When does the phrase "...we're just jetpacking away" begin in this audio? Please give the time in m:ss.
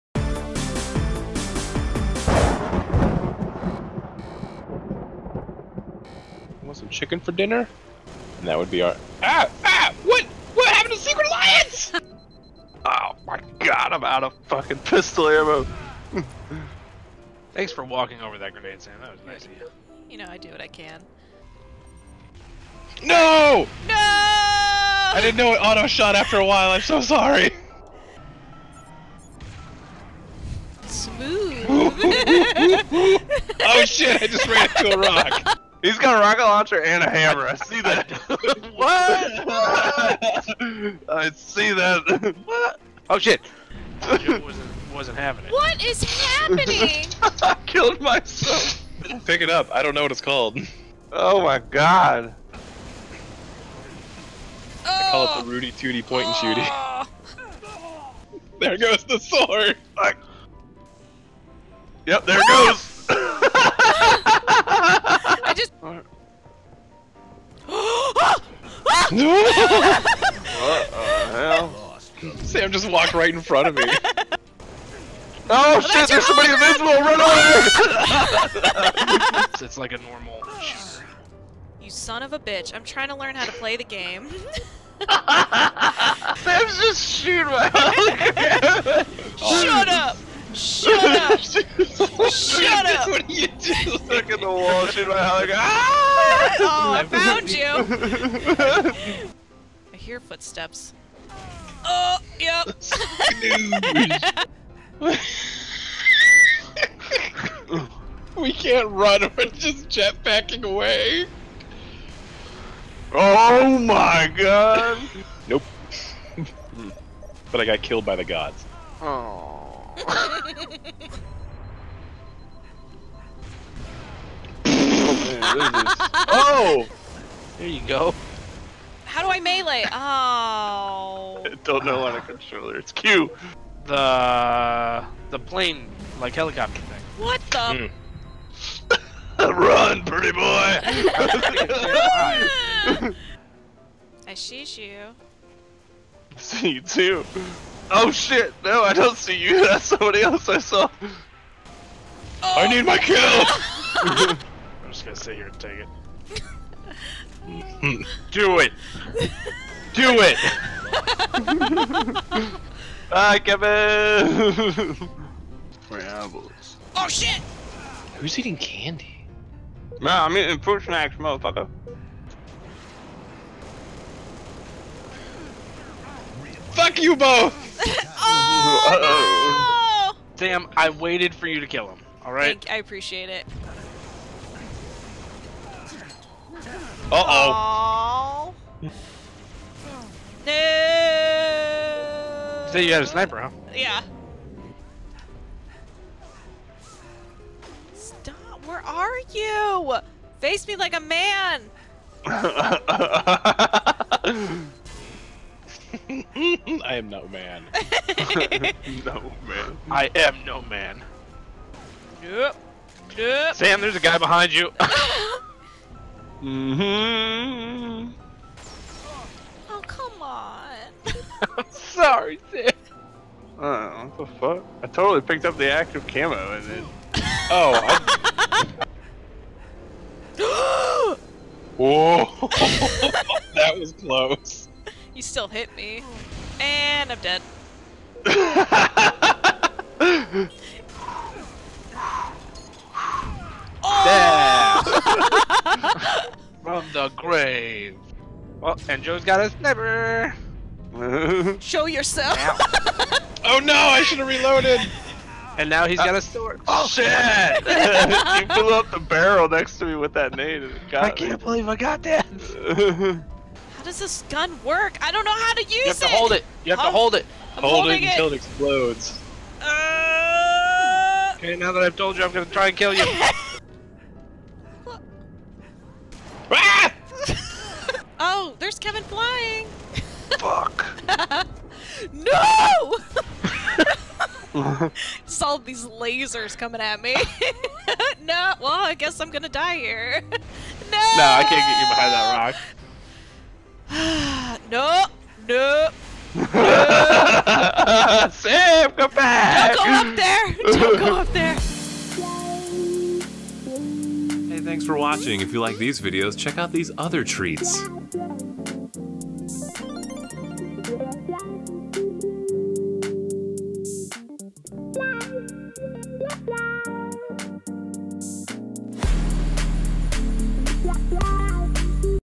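1:49.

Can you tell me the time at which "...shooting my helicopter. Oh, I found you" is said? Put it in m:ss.
1:34.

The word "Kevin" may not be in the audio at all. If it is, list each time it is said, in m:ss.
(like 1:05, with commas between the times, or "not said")
2:43, 4:38.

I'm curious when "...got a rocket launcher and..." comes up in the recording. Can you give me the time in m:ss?
0:35.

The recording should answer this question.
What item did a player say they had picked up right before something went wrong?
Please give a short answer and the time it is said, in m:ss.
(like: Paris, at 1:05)
Active camo, at 3:45.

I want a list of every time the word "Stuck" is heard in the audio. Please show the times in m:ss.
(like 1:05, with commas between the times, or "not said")
1:33.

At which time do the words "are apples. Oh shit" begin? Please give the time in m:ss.
2:45.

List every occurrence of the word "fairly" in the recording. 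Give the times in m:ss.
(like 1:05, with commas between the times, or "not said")
not said.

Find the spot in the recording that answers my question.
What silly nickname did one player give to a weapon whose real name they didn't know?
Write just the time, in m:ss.
0:55.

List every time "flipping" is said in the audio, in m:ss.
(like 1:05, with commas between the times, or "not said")
not said.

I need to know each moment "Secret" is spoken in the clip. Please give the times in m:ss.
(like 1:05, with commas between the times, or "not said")
0:10.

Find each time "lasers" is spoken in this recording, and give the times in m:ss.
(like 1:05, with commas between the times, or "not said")
4:45.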